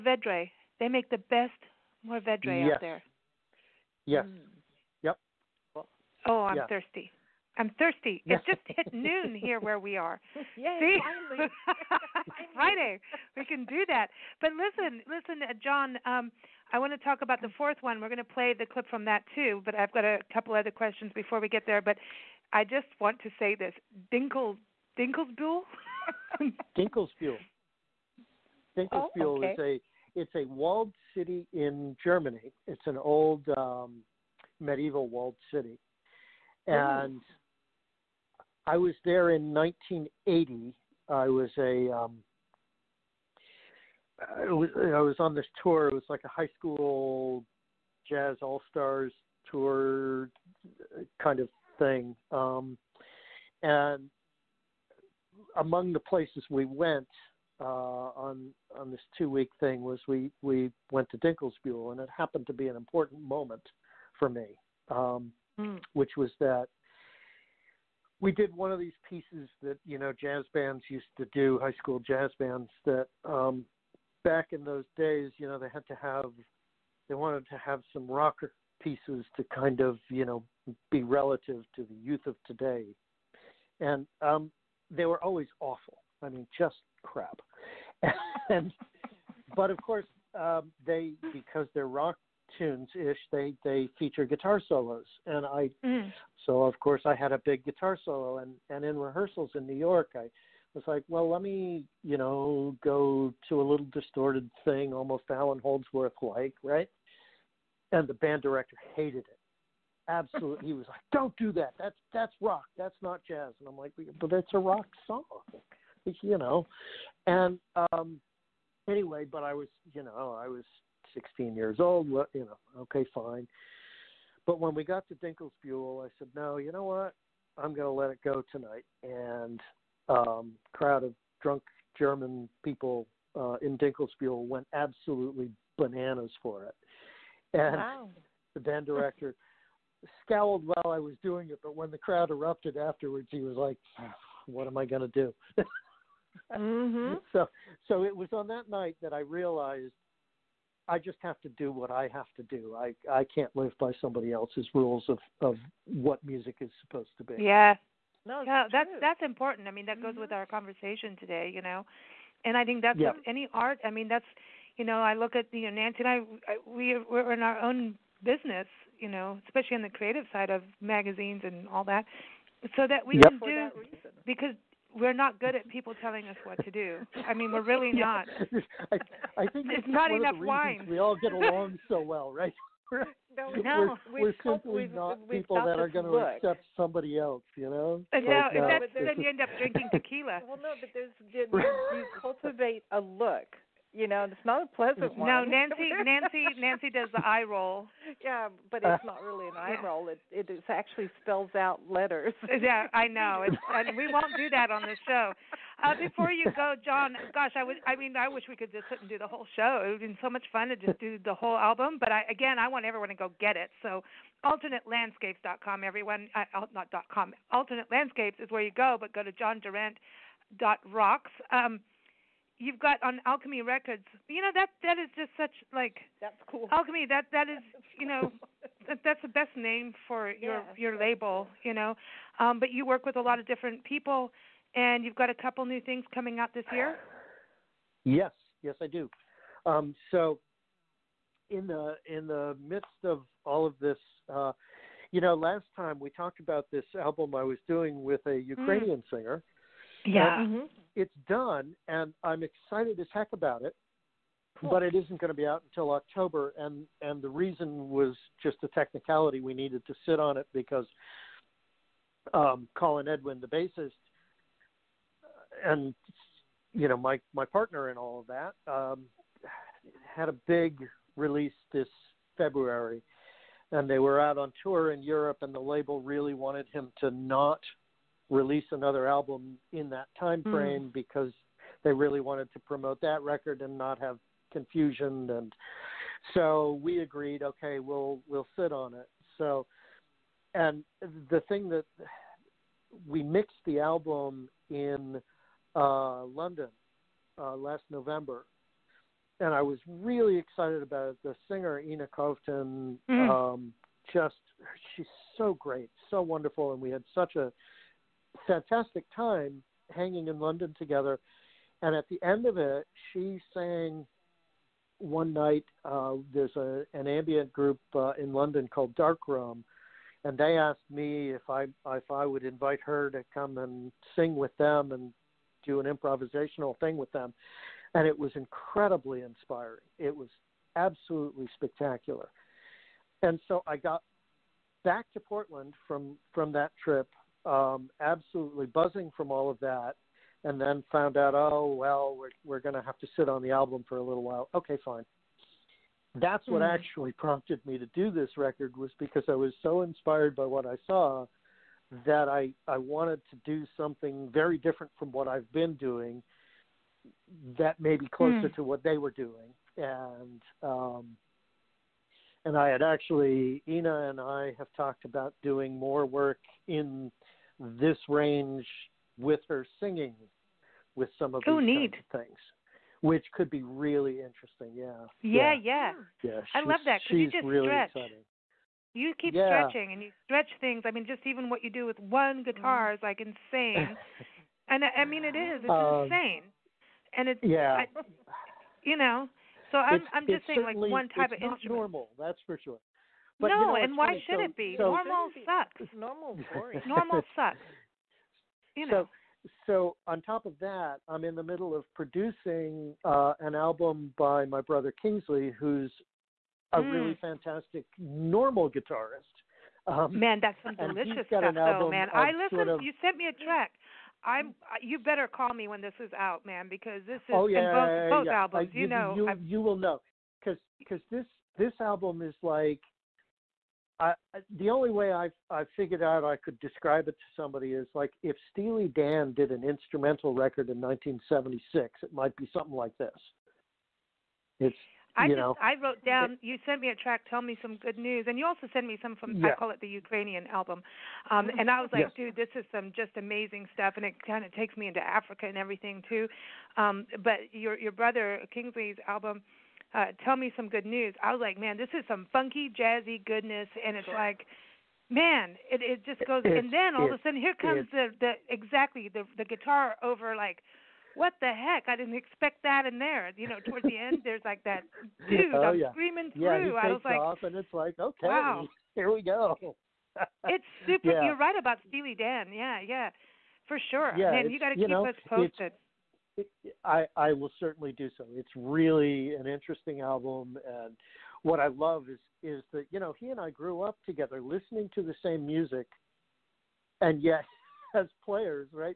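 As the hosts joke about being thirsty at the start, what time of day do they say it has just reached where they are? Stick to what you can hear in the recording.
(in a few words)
noon.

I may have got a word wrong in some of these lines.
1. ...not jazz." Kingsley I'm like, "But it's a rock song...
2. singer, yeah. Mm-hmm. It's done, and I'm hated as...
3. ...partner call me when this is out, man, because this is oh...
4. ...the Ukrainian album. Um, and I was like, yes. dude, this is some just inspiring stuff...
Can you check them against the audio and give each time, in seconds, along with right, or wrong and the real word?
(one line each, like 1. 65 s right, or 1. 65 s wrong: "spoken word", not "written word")
1. 113 s wrong: "And", not "Kingsley"
2. 249 s wrong: "excited", not "hated"
3. 414 s wrong: "better", not "partner"
4. 439 s wrong: "amazing", not "inspiring".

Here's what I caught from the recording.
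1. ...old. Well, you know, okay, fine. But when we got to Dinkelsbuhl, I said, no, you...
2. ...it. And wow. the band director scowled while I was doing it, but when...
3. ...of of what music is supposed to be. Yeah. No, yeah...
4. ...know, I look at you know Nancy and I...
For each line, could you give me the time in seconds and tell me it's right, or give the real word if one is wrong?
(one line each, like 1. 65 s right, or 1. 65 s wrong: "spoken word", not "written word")
1. 121 s right
2. 136 s right
3. 155 s right
4. 164 s right.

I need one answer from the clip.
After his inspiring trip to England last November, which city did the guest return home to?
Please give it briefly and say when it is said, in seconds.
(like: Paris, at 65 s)
Portland, at 335 s.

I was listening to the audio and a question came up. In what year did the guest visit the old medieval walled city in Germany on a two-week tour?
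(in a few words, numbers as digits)
1980.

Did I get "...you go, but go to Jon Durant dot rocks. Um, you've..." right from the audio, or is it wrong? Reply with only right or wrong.
right.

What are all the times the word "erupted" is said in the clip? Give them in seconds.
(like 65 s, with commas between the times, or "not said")
142 s.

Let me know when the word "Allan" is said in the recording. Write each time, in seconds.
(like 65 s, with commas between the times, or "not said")
105 s.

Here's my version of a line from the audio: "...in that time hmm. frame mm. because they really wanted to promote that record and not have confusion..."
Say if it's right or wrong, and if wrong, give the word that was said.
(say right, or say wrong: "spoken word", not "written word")
right.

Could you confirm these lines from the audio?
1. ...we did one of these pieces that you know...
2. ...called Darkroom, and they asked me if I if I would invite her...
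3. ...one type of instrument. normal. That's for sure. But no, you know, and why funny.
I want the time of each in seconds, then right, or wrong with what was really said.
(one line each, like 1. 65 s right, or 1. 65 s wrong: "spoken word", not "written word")
1. 68 s right
2. 318 s right
3. 390 s right.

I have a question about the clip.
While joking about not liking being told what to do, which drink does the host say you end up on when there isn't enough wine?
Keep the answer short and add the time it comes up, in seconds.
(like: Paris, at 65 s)
tequila, at 189 s.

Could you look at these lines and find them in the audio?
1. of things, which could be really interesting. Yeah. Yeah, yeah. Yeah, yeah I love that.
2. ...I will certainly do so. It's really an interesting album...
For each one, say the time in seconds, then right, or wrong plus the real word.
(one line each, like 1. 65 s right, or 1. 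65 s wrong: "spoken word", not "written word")
1. 372 s right
2. 477 s right.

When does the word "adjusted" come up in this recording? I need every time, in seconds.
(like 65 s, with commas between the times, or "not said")
not said.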